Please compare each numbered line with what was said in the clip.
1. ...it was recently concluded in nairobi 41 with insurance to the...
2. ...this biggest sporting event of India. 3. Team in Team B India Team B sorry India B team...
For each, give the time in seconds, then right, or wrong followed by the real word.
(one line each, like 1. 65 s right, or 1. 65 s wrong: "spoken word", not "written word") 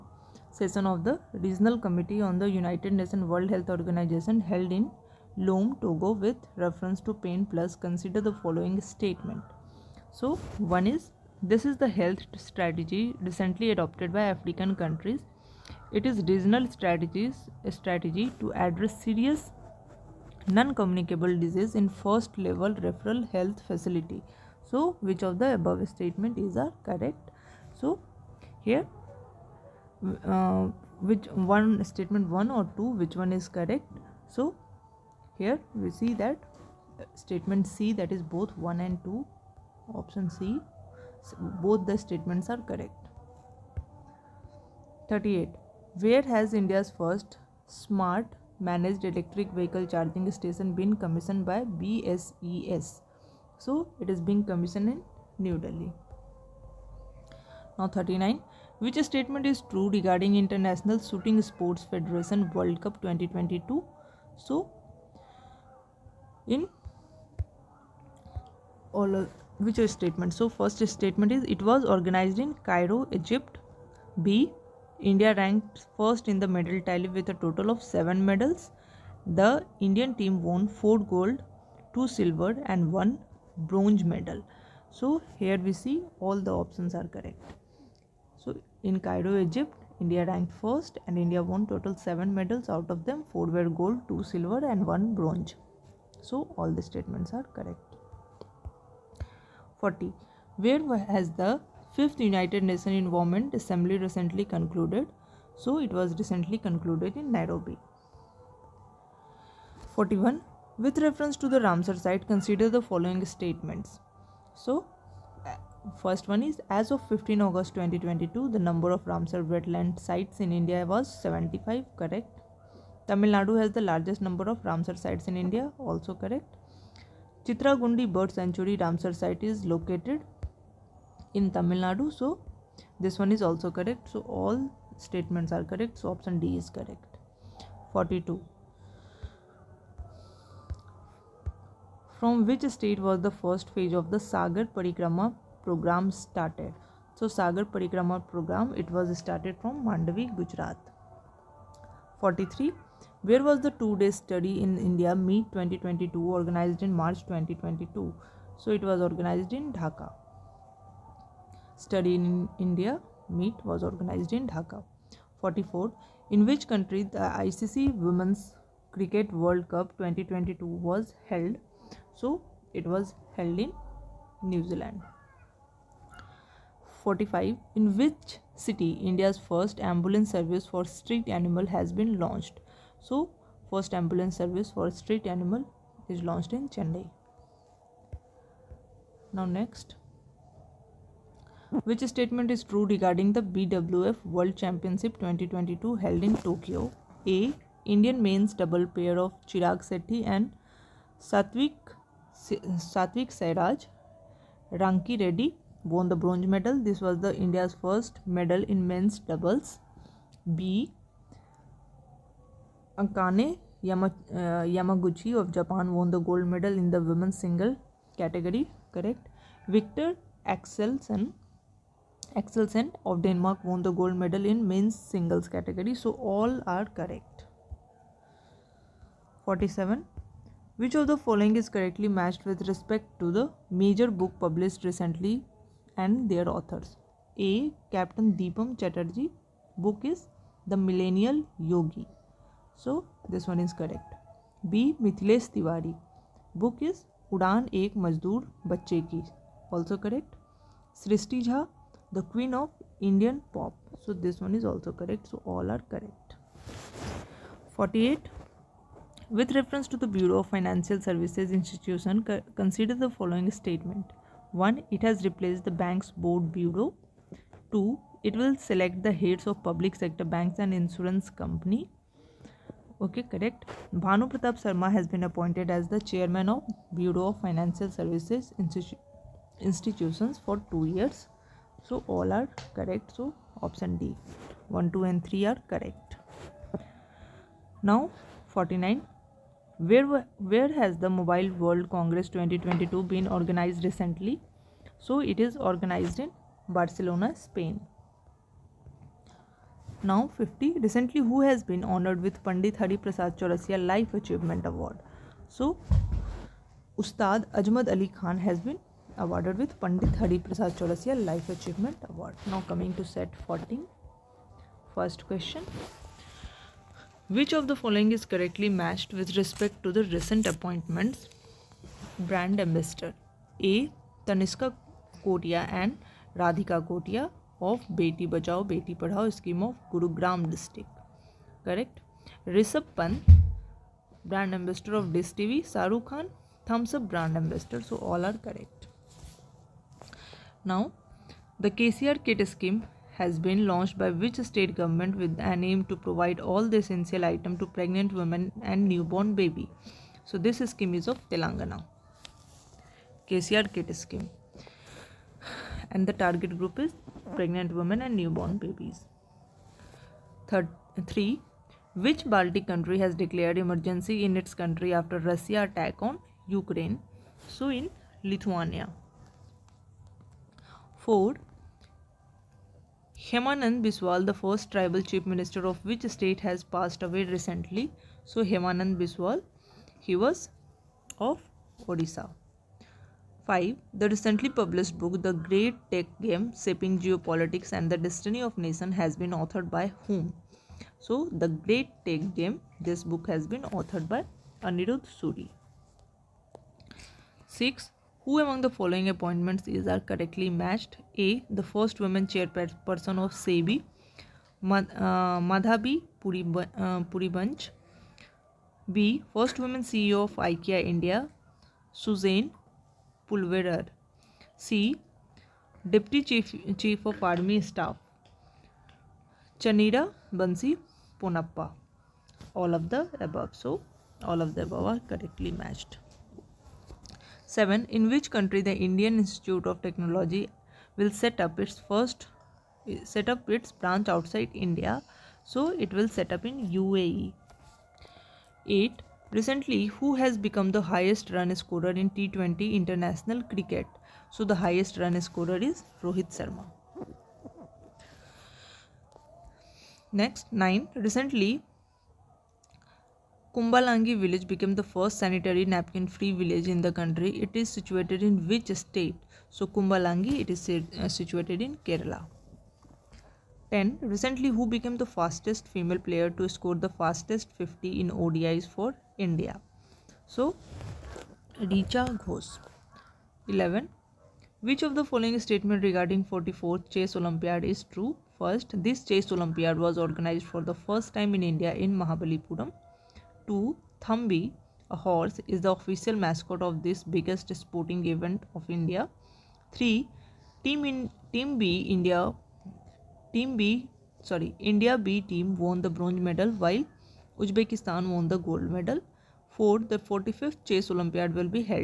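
1. 105 s wrong: "reference", not "insurance"
2. 486 s right.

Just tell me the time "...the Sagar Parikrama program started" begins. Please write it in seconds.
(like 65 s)
144 s.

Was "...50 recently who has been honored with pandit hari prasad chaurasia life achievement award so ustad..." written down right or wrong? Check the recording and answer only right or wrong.
right.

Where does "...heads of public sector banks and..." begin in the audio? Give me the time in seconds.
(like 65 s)
269 s.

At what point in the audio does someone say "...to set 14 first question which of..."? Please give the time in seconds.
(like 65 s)
312 s.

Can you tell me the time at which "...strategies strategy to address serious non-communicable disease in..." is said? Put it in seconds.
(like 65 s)
16 s.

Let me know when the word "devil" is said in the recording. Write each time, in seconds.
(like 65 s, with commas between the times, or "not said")
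not said.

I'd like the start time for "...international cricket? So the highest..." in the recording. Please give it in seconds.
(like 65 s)
442 s.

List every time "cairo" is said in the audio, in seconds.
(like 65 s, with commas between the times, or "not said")
72 s, 88 s.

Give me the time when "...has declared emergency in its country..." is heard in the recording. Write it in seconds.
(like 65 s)
362 s.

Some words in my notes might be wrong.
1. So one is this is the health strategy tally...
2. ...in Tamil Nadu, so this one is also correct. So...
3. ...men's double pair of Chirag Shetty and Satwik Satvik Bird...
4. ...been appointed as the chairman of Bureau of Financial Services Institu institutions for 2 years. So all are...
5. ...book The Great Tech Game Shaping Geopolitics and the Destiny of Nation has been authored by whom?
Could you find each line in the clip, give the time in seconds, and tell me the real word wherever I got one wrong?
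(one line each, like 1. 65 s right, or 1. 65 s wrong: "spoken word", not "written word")
1. 10 s wrong: "recently", not "tally"
2. 131 s right
3. 198 s wrong: "Sairaj", not "Bird"
4. 275 s right
5. 384 s right.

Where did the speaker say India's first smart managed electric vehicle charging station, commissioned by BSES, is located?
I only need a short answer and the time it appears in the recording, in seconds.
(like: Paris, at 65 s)
New Delhi, at 55 s.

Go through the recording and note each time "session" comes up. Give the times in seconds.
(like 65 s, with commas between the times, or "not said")
0 s.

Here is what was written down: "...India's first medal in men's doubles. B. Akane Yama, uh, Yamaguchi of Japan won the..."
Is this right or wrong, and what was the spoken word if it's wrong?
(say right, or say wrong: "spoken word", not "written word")
right.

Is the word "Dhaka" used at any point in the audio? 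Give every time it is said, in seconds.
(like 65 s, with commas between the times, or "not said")
159 s, 164 s.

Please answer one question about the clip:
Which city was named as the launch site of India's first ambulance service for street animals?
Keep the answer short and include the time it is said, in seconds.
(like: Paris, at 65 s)
Chennai, at 186 s.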